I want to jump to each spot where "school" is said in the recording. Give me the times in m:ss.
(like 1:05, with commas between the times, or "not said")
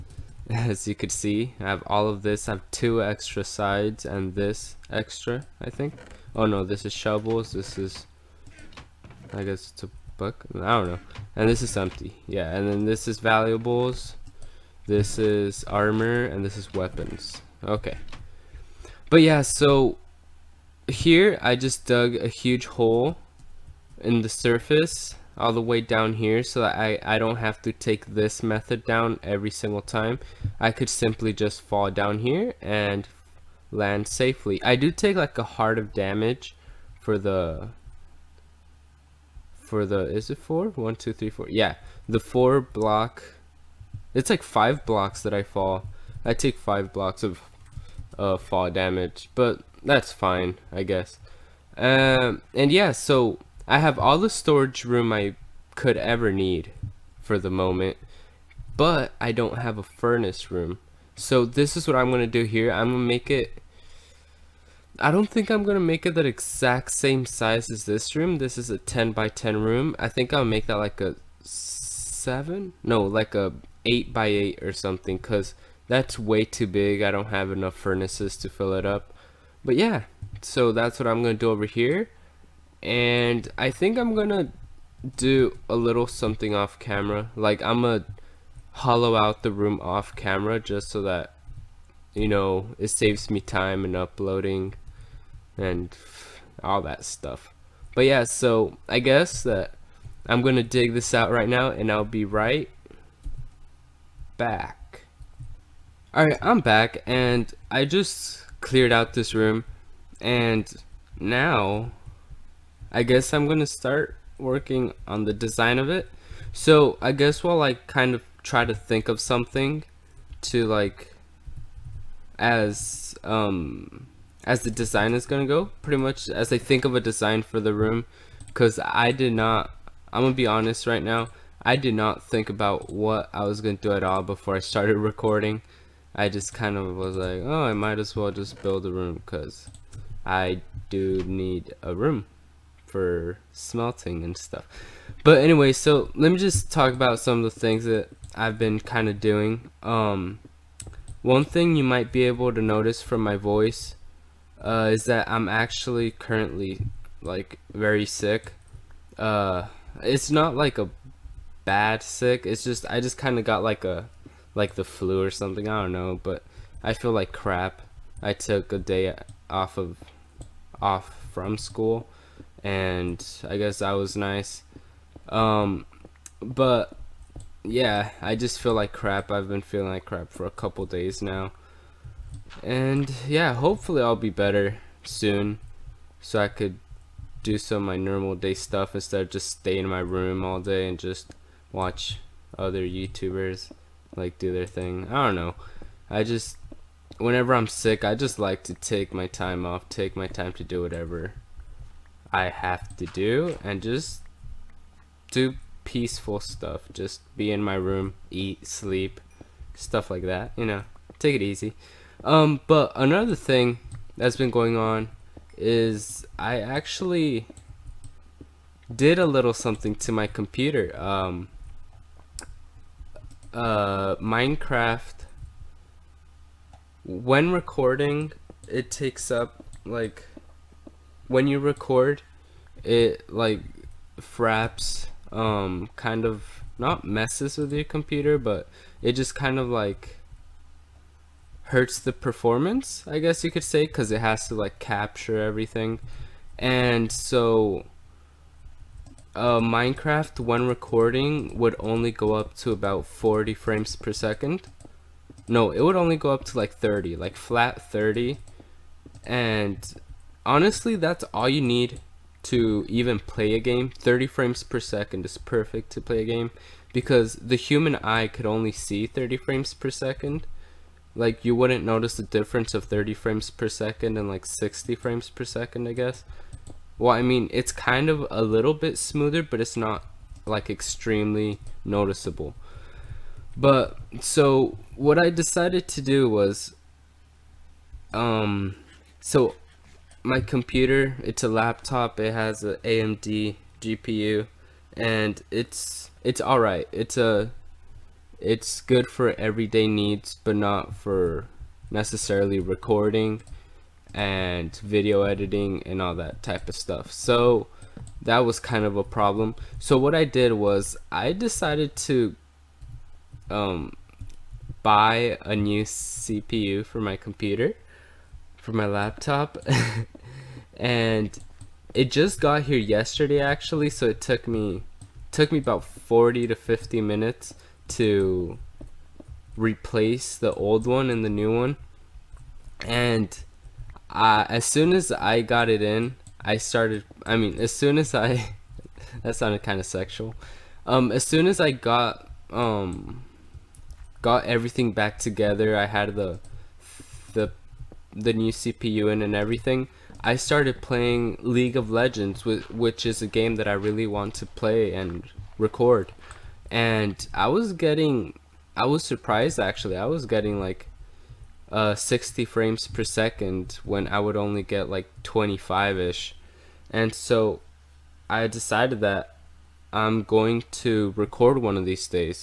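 2:51.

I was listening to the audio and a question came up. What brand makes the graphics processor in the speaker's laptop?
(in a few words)
AMD.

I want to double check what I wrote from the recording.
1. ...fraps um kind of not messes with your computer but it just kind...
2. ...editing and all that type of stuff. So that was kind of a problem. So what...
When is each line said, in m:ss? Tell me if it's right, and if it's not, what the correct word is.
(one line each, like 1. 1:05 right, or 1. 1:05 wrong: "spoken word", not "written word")
1. 3:54 right
2. 5:05 right.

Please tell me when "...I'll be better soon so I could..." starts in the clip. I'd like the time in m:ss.
3:04.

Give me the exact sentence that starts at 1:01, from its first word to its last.
So this is what I'm going to do here.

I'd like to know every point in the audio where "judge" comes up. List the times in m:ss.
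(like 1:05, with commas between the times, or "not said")
not said.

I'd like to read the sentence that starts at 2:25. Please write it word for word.
But anyway, so let me just talk about some of the things that I've been kind of doing.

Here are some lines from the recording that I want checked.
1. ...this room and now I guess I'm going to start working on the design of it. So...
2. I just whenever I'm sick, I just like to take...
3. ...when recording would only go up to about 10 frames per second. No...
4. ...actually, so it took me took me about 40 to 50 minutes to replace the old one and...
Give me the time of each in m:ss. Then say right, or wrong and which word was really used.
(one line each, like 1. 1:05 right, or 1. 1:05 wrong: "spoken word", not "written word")
1. 1:49 right
2. 3:16 right
3. 4:10 wrong: "40", not "10"
4. 5:23 right.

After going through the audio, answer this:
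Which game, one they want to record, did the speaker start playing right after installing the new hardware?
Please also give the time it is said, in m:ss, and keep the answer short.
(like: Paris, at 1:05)
League of Legends, at 5:51.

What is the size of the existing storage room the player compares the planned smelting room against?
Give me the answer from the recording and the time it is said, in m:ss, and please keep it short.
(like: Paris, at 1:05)
10 by 10, at 1:08.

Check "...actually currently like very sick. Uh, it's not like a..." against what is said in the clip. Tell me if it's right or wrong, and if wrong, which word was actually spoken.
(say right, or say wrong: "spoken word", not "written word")
right.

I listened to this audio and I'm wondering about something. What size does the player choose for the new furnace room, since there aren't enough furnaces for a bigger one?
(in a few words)
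8 by 8.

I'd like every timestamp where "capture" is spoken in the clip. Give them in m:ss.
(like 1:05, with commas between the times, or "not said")
4:04.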